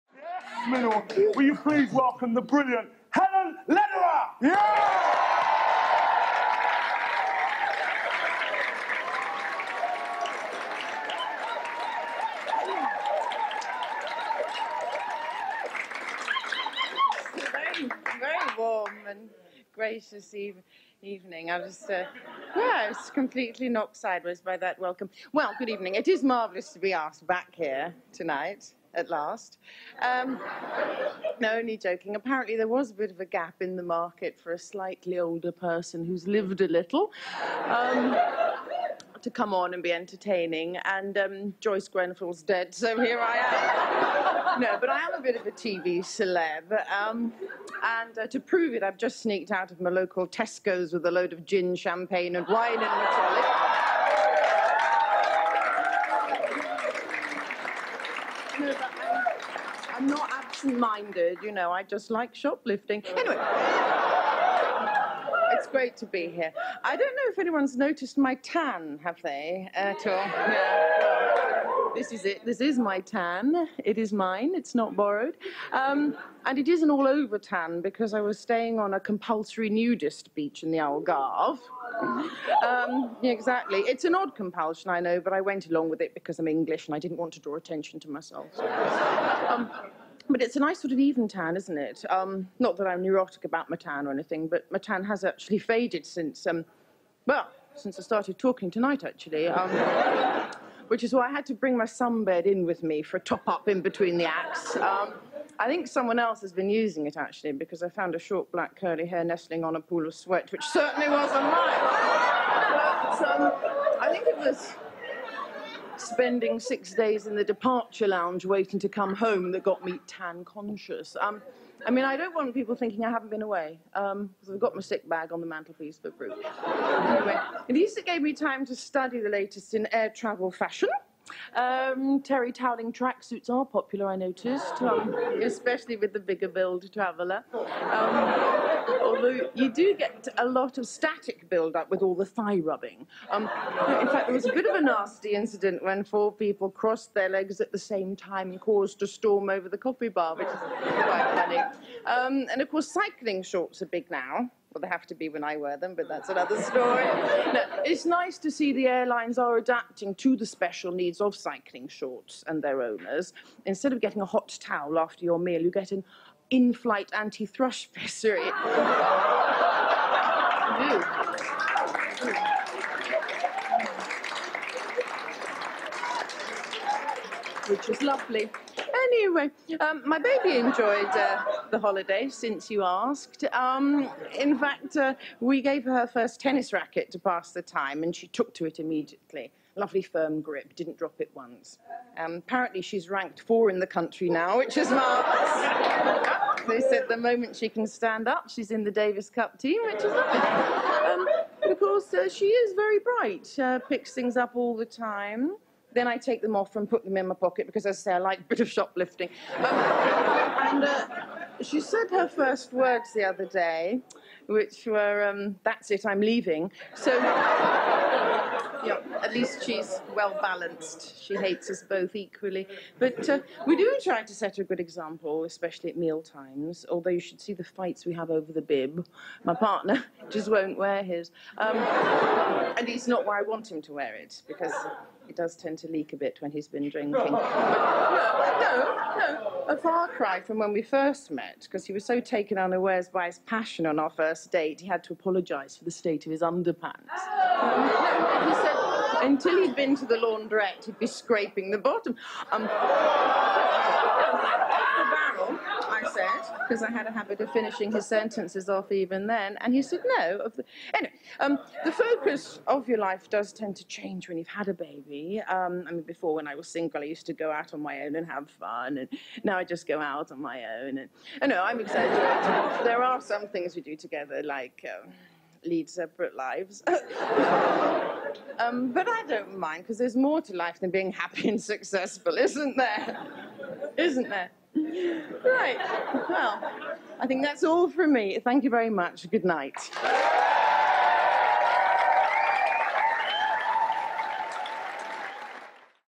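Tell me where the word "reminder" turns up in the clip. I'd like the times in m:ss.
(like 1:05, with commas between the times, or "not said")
not said.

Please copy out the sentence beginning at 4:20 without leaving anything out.
Anyway, um, the focus of your life does tend to change when you've had a baby.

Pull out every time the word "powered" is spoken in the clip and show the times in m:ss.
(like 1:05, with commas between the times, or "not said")
not said.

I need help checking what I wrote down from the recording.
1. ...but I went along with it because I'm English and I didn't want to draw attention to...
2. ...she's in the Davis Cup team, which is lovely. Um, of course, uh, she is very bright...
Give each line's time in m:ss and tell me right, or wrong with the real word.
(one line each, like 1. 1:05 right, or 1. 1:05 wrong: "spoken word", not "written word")
1. 1:25 right
2. 3:18 right.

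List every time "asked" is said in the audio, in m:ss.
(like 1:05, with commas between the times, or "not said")
0:26, 3:02.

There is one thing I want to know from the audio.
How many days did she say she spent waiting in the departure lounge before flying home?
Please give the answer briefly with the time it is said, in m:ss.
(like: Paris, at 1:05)
6, at 1:56.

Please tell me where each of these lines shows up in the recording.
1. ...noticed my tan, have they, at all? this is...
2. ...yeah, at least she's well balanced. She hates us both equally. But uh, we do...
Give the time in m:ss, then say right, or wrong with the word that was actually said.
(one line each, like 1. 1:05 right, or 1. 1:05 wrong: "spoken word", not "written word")
1. 1:07 right
2. 3:38 right.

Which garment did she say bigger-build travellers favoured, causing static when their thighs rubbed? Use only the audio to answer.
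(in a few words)
Terry toweling tracksuits.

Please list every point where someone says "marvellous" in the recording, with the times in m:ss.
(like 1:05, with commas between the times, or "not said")
0:26, 3:14.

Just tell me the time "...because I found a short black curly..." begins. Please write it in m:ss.
1:47.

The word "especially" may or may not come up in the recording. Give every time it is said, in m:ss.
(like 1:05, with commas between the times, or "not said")
2:15, 3:45.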